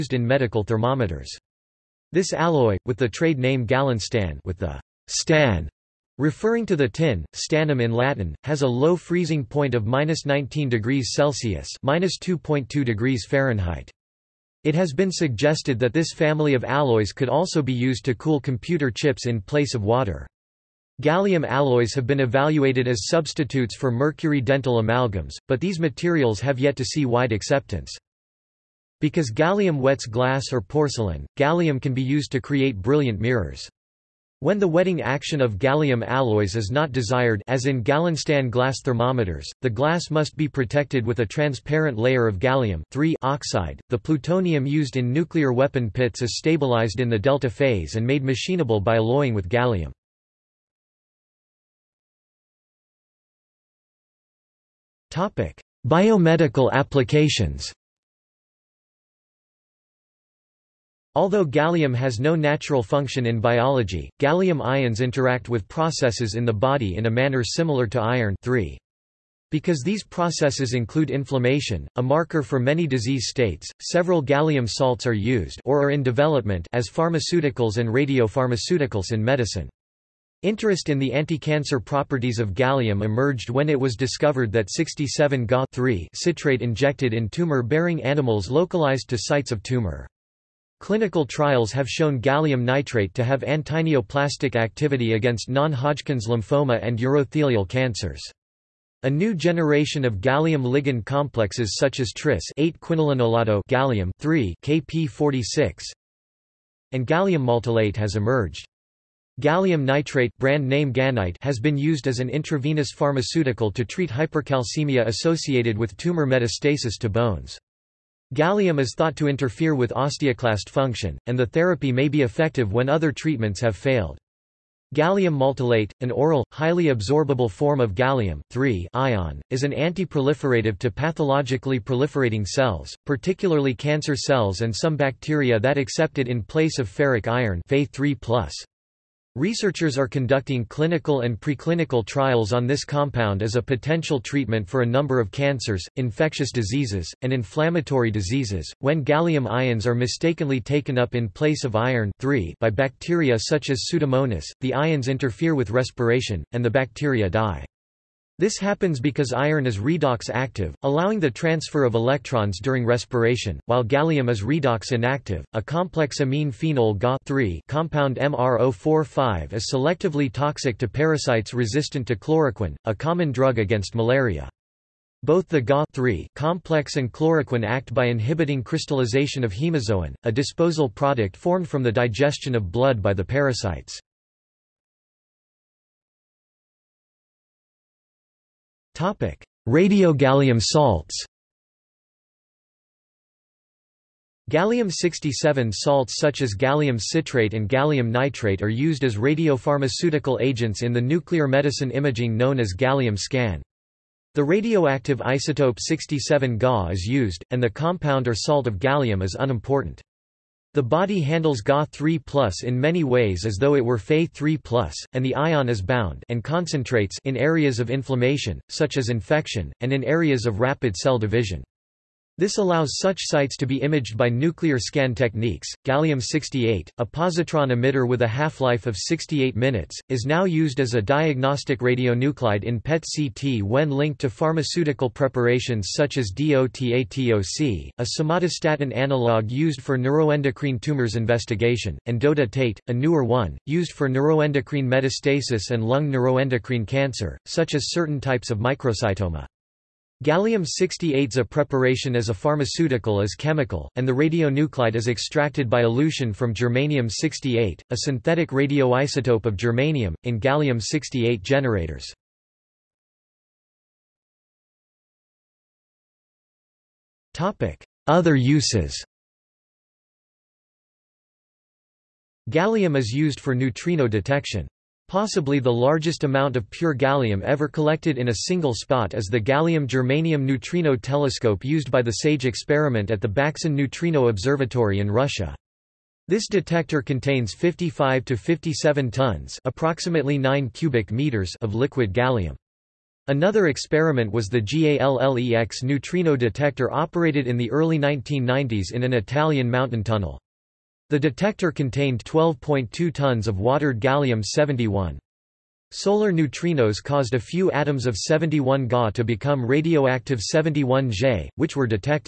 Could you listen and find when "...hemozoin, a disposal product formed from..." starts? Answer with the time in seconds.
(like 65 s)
179 s.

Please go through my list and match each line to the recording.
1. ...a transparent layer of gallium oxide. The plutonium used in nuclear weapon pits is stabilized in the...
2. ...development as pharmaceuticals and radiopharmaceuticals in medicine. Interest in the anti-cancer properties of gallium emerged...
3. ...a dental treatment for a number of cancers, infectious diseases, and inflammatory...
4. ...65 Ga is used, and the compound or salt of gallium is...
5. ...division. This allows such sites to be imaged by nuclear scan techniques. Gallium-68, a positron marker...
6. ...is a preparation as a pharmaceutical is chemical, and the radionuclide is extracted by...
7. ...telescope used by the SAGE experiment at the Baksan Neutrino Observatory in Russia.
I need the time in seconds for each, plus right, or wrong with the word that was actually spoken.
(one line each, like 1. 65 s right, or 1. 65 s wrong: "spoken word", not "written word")
1. 41 s right
2. 76 s right
3. 143 s wrong: "potential", not "dental"
4. 205 s wrong: "67", not "65"
5. 221 s wrong: "emitter", not "marker"
6. 251 s right
7. 280 s right.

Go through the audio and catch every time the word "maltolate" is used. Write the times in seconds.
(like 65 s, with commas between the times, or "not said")
107 s, 125 s.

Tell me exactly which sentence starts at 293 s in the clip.
Another experiment was the GALLEX neutrino detector operated in the early 1990s in an Italian mountain tunnel.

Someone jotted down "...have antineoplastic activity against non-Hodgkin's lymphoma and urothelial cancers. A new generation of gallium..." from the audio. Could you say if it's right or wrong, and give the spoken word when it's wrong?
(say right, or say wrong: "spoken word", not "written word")
right.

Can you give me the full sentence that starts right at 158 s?
This happens because iron is redox active, allowing the transfer of electrons during respiration, while gallium is redox inactive.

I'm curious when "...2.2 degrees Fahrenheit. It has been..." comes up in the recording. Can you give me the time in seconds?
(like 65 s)
12 s.